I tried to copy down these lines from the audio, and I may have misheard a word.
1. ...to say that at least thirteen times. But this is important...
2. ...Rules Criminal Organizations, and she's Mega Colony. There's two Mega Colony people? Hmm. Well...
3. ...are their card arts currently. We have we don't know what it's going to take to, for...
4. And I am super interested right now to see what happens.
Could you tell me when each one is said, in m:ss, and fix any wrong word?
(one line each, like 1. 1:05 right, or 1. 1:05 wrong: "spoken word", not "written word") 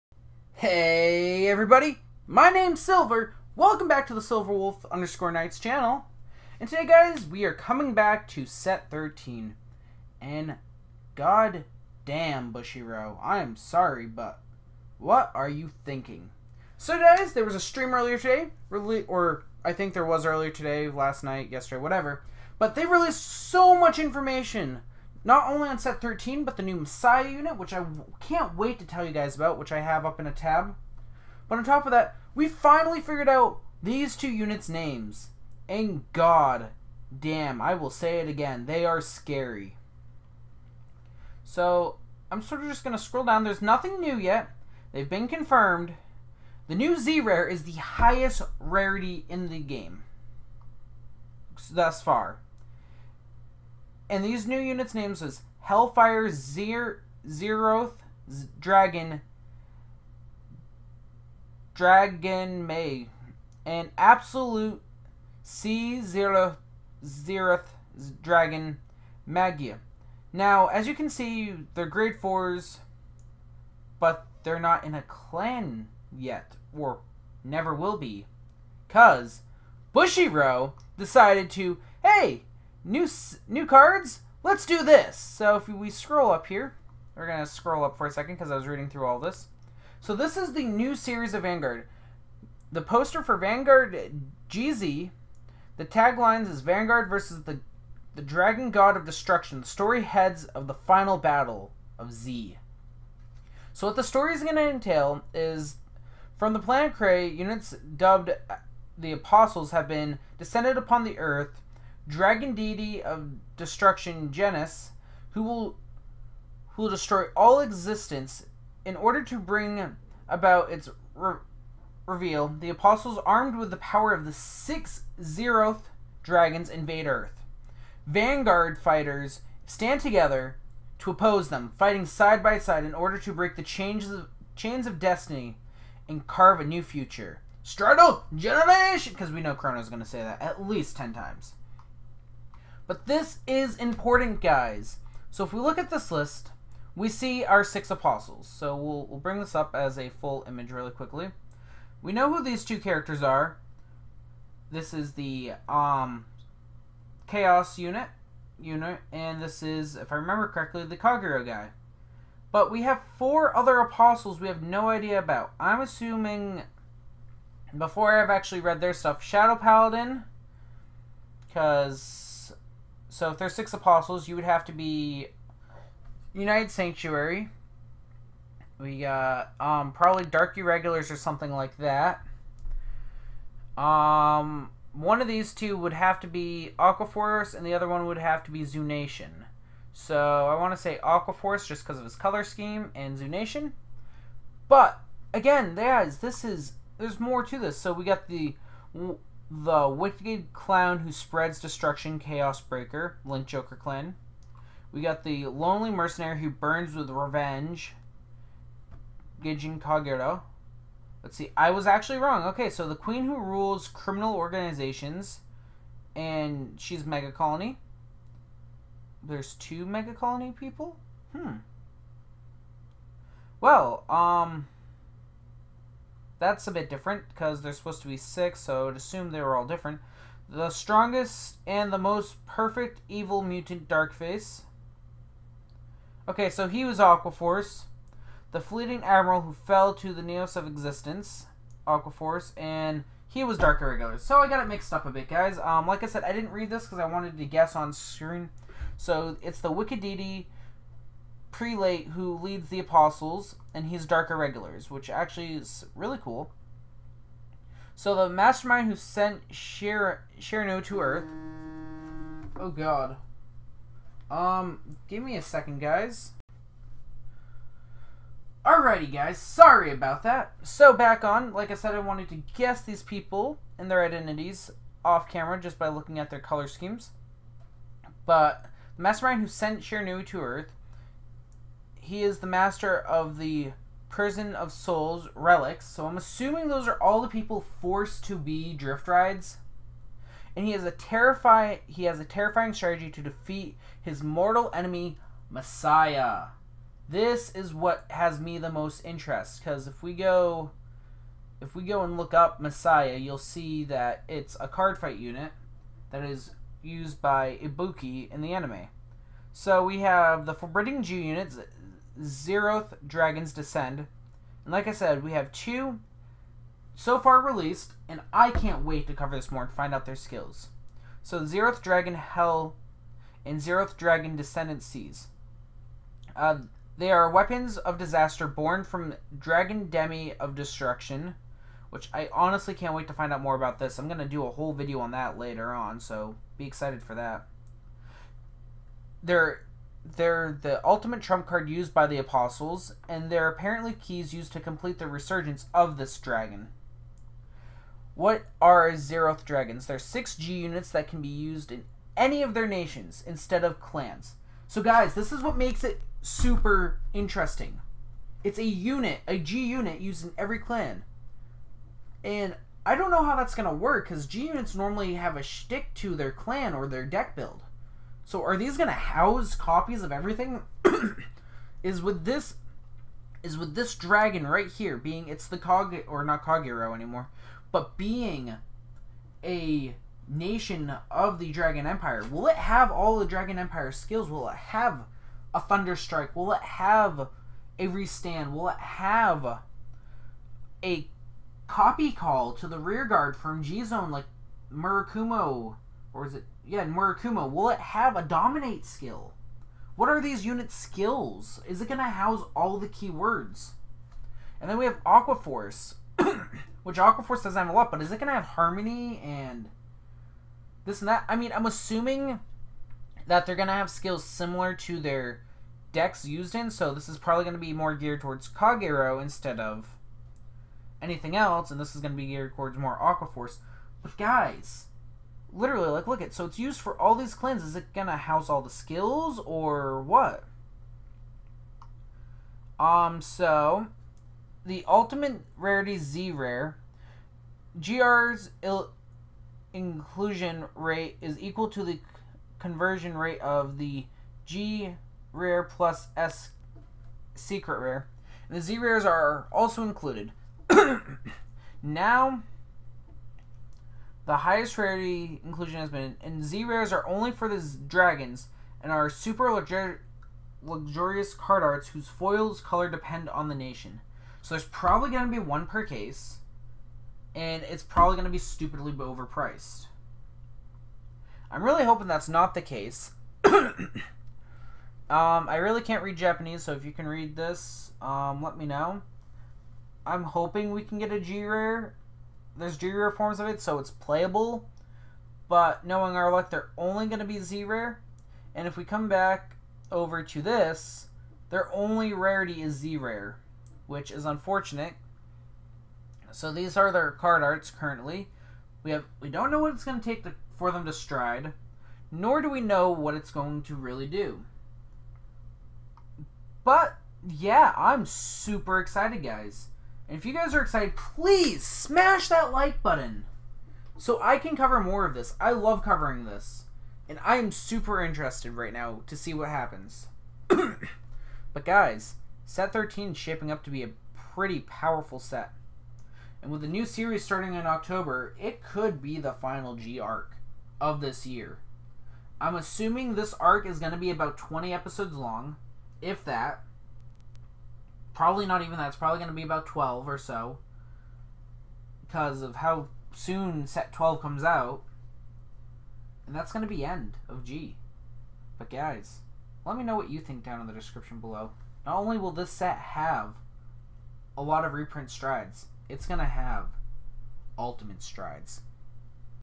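1. 2:20 wrong: "ten", not "thirteen"
2. 3:33 right
3. 8:16 right
4. 8:37 right.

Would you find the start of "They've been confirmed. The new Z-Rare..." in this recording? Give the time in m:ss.
0:44.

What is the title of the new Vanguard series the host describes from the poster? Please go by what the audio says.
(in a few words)
Vanguard GZ.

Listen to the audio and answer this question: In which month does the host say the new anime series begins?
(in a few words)
October.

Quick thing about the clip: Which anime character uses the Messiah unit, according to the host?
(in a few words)
Ibuki.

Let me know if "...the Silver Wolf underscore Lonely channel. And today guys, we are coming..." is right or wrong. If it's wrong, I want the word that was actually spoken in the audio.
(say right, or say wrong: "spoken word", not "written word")
wrong: "Knights", not "Lonely".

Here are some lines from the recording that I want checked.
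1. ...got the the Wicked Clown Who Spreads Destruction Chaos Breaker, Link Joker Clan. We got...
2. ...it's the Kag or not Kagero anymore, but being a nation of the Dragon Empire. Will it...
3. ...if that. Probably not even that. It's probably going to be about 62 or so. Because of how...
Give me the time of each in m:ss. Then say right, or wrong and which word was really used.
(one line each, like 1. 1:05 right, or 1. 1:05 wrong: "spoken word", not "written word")
1. 3:18 right
2. 6:15 right
3. 8:56 wrong: "12", not "62".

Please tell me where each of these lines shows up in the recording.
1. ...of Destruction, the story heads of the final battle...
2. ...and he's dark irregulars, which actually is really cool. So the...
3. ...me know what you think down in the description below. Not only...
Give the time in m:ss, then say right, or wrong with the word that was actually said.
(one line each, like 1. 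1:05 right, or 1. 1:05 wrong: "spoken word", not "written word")
1. 1:38 right
2. 4:13 right
3. 9:09 right.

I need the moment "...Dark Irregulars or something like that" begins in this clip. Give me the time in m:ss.
3:00.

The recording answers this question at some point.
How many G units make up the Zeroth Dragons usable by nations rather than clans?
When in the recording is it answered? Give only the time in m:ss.
5:49.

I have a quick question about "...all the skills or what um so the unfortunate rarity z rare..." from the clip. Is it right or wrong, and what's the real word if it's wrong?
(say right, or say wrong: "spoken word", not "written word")
wrong: "ultimate", not "unfortunate".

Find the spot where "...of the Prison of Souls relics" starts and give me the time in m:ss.
4:42.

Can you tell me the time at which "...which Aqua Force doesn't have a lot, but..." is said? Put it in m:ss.
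6:46.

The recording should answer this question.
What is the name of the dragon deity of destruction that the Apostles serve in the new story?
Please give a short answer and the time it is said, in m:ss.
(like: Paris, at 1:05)
Genis, at 1:54.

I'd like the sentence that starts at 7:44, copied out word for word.
So there's probably going to be one per case, and it's probably going to be stupidly overpriced.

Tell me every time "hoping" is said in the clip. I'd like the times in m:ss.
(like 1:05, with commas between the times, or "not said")
7:51, 8:00.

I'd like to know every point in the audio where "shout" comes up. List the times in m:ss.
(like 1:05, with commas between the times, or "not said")
not said.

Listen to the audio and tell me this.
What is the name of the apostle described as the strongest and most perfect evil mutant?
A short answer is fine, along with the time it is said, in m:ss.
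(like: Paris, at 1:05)
Darkface, at 3:53.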